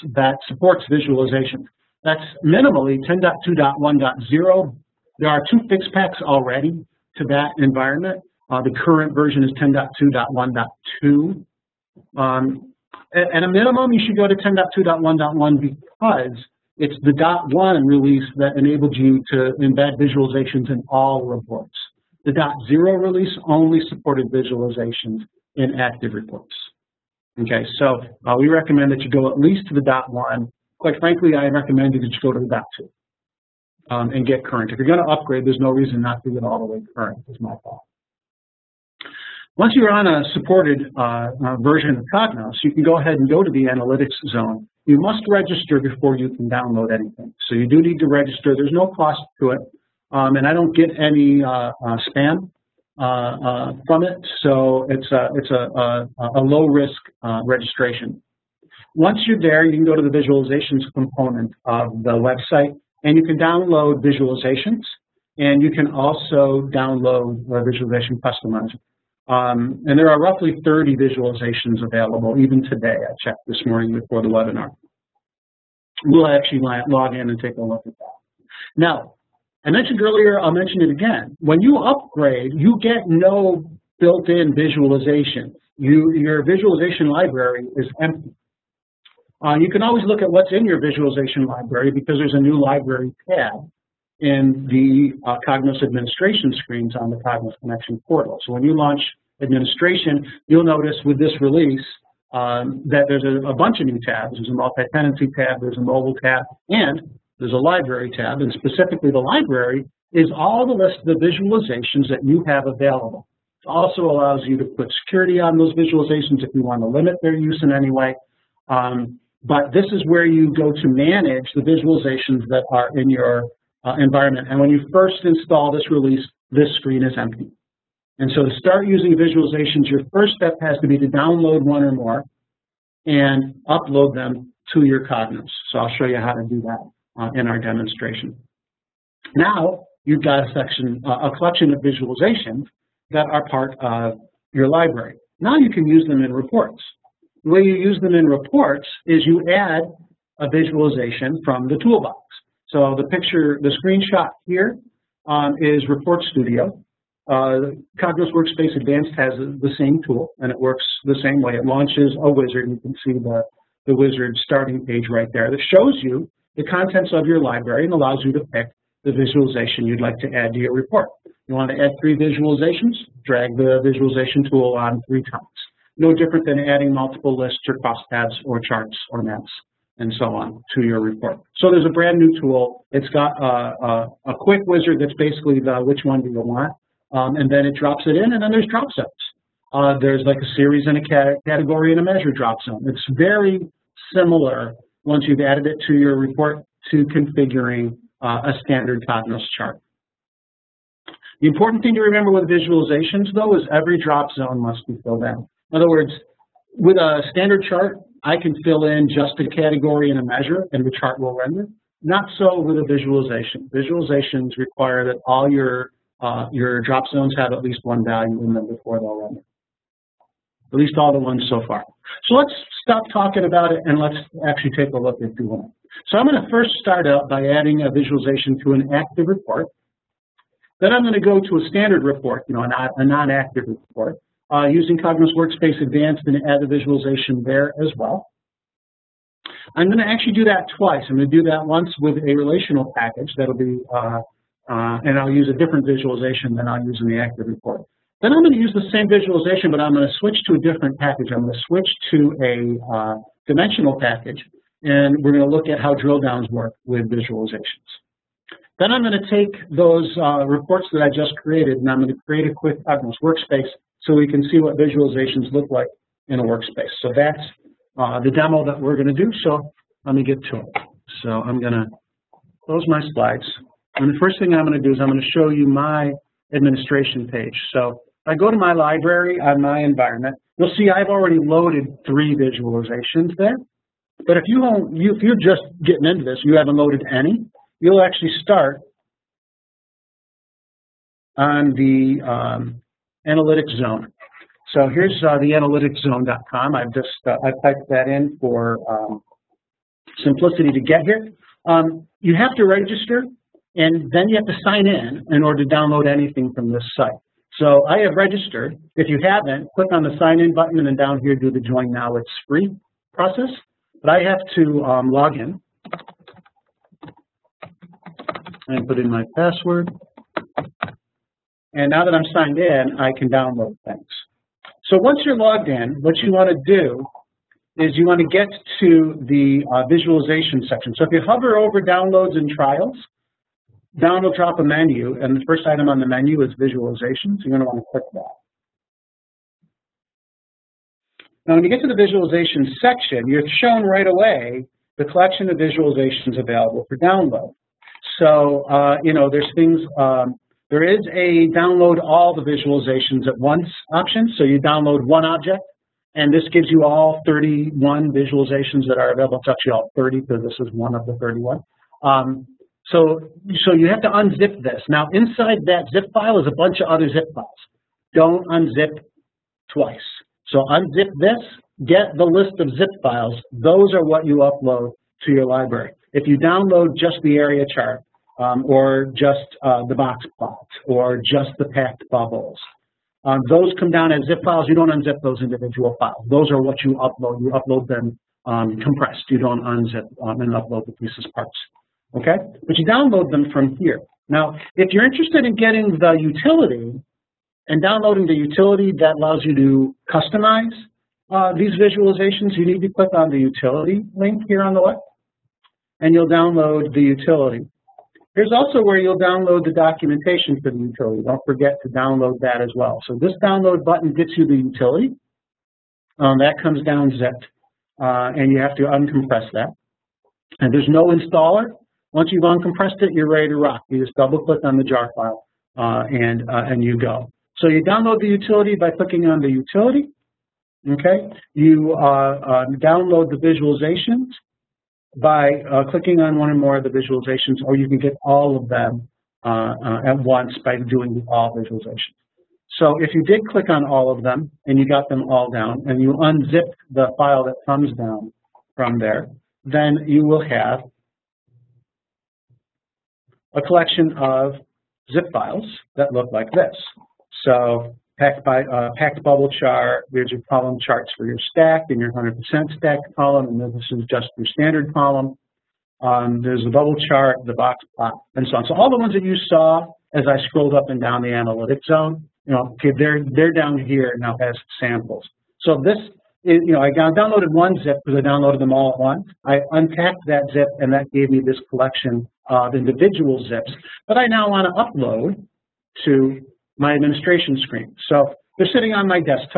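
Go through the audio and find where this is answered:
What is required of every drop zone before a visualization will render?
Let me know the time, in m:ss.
3:24.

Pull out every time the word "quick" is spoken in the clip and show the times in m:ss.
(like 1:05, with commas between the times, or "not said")
3:04, 4:22.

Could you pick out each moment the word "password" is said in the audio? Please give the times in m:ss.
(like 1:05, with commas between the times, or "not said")
5:19.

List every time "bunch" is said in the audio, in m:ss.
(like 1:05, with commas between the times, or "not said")
1:43, 6:06.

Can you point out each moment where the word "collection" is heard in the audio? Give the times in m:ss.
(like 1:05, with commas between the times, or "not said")
2:21, 5:45, 7:33, 8:01.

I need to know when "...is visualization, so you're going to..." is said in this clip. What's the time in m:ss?
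5:36.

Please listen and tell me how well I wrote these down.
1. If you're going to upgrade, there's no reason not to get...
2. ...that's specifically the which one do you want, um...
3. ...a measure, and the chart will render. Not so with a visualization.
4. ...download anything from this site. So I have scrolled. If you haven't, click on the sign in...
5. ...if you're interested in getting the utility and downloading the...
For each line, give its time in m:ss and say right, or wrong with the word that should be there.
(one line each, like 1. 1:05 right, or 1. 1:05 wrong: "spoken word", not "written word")
1. 0:34 right
2. 3:05 wrong: "basically", not "specifically"
3. 3:30 right
4. 5:05 wrong: "registered", not "scrolled"
5. 6:34 right.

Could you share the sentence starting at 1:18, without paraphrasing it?
Now, I mentioned earlier, I'll mention it again.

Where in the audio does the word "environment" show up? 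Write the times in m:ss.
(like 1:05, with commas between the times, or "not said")
0:07, 2:03, 4:39.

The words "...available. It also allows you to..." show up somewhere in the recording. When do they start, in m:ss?
1:52.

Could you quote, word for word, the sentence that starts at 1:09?
Um, and there are roughly 30 visualizations available, even today.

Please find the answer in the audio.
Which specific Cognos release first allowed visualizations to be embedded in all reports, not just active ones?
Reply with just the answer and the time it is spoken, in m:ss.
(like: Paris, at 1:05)
10.2.1.1, at 0:14.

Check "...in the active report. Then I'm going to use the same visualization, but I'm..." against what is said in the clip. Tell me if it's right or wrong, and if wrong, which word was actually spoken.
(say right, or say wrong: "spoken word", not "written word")
right.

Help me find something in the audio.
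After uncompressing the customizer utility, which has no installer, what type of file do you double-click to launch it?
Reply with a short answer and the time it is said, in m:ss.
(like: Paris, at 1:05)
Jar file, at 7:04.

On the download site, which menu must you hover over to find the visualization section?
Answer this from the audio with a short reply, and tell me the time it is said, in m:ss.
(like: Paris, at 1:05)
Downloads and trials, at 5:31.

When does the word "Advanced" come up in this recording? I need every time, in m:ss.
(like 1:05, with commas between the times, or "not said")
2:38, 3:55.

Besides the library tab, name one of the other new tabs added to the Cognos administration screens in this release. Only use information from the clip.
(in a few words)
Multi-tenancy.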